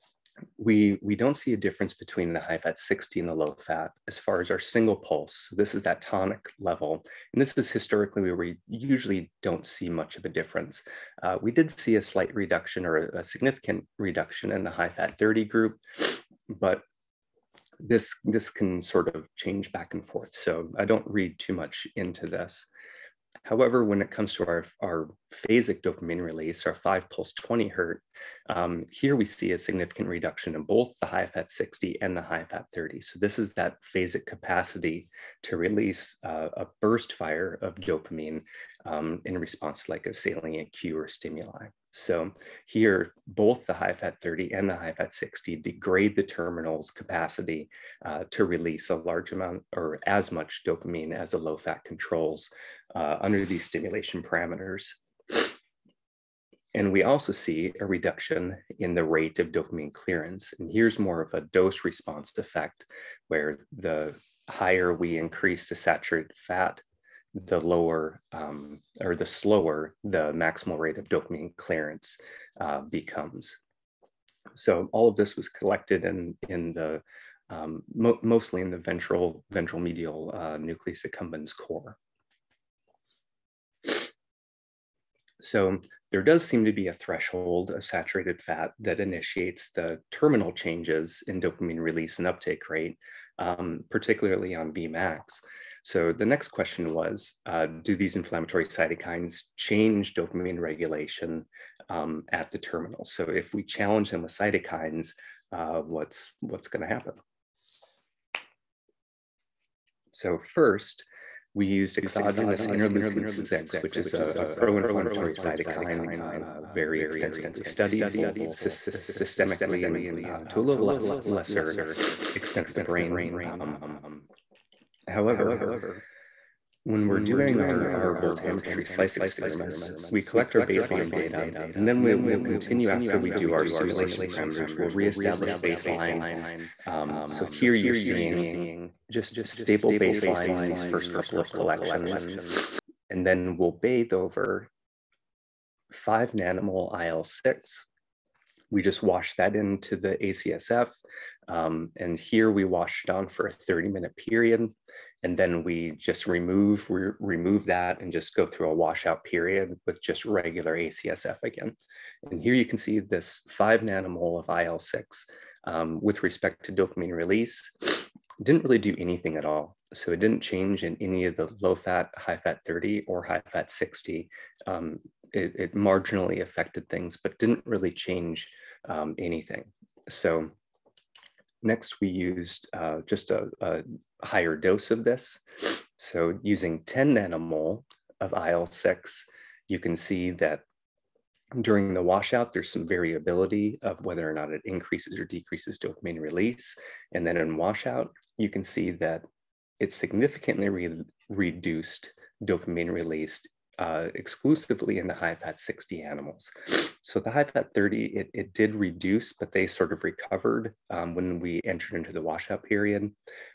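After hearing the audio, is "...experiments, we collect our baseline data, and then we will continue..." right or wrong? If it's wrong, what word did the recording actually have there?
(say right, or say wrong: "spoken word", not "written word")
right.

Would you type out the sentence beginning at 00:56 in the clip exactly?
And we also see a reduction in the rate of dopamine clearance.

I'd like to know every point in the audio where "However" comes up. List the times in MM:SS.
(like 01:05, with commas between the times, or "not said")
00:23, 02:05.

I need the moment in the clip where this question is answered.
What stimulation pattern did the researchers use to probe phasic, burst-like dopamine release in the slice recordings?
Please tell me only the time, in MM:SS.
00:26.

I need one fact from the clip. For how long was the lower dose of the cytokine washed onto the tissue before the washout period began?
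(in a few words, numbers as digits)
30 minutes.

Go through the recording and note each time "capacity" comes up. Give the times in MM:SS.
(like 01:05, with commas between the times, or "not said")
00:34, 00:46.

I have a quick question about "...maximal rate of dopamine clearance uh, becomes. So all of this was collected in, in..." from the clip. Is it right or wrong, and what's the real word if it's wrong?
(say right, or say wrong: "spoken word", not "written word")
right.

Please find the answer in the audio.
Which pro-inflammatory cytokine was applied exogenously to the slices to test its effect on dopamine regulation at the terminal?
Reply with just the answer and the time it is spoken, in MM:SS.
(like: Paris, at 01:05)
interleukin-6, at 01:52.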